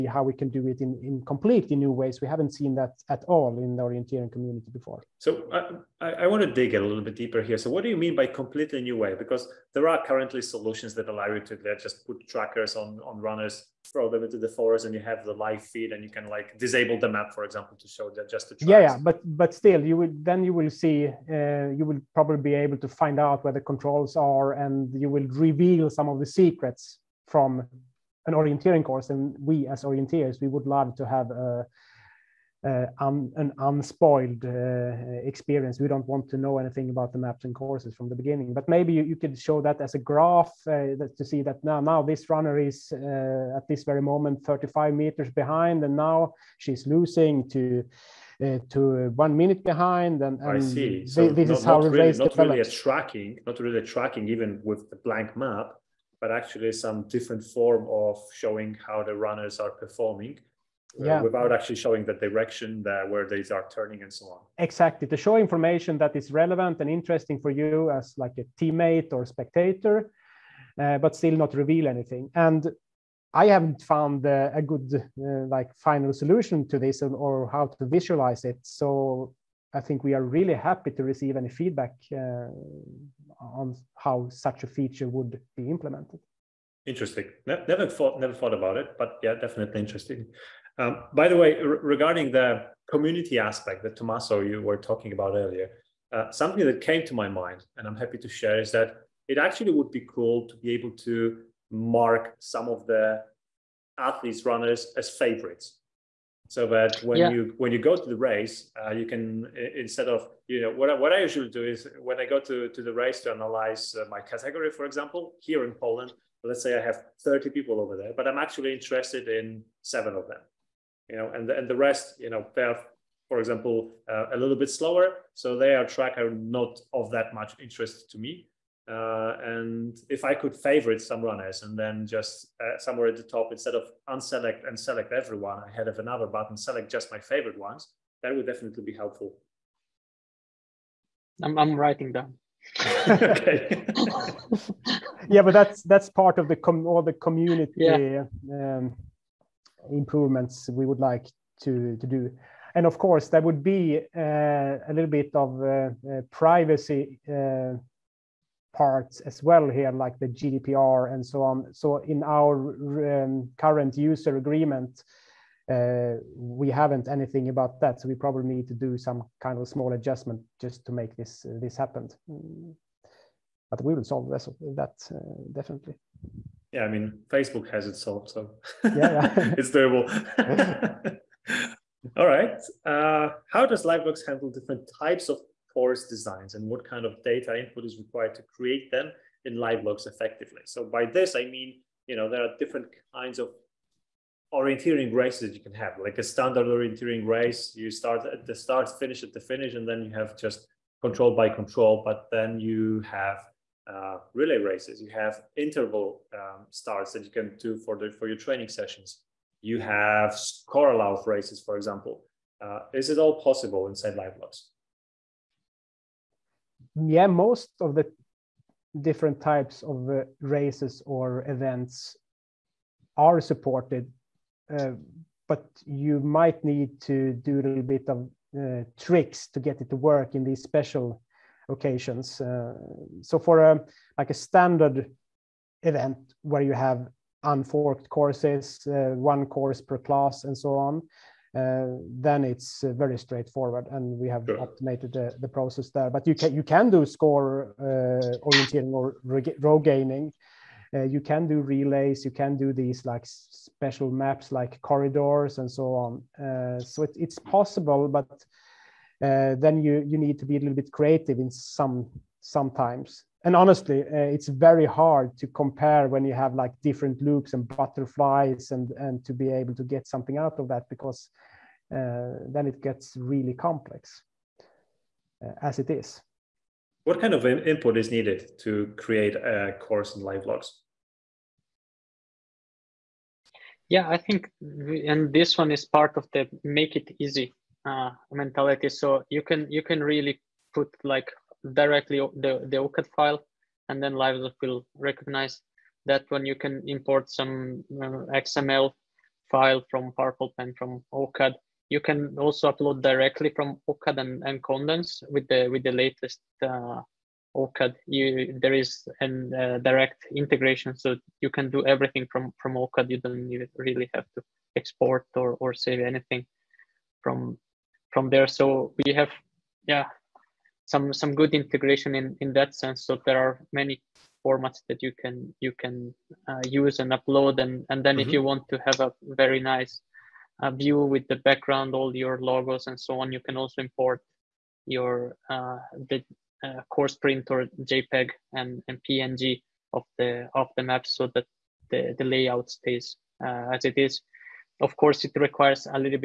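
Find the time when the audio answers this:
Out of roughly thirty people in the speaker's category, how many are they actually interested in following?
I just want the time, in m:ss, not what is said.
1:59.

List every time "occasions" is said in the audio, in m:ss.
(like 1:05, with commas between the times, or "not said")
3:51.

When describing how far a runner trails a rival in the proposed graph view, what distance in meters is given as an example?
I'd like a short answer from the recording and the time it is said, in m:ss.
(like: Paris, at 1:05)
35 meters, at 0:44.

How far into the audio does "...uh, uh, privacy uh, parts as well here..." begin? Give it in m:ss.
2:35.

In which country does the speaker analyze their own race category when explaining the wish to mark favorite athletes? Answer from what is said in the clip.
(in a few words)
Poland.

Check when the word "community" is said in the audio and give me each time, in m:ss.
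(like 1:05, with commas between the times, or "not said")
0:04, 1:32, 2:27.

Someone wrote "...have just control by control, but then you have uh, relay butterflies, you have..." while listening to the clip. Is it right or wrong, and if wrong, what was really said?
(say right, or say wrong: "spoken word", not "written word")
wrong: "races", not "butterflies".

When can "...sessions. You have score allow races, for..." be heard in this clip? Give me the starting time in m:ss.
3:28.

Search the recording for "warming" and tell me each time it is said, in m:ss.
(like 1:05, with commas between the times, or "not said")
not said.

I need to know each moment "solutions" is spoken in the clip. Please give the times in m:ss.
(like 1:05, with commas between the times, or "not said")
0:10, 1:16.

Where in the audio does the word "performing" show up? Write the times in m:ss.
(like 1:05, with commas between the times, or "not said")
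0:59.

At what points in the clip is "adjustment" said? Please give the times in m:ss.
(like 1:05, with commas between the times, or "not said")
2:49.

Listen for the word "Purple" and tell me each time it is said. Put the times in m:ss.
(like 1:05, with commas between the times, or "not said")
5:00.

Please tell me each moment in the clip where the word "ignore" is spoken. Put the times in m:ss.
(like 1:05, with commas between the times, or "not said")
not said.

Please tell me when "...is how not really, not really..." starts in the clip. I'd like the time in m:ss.
0:51.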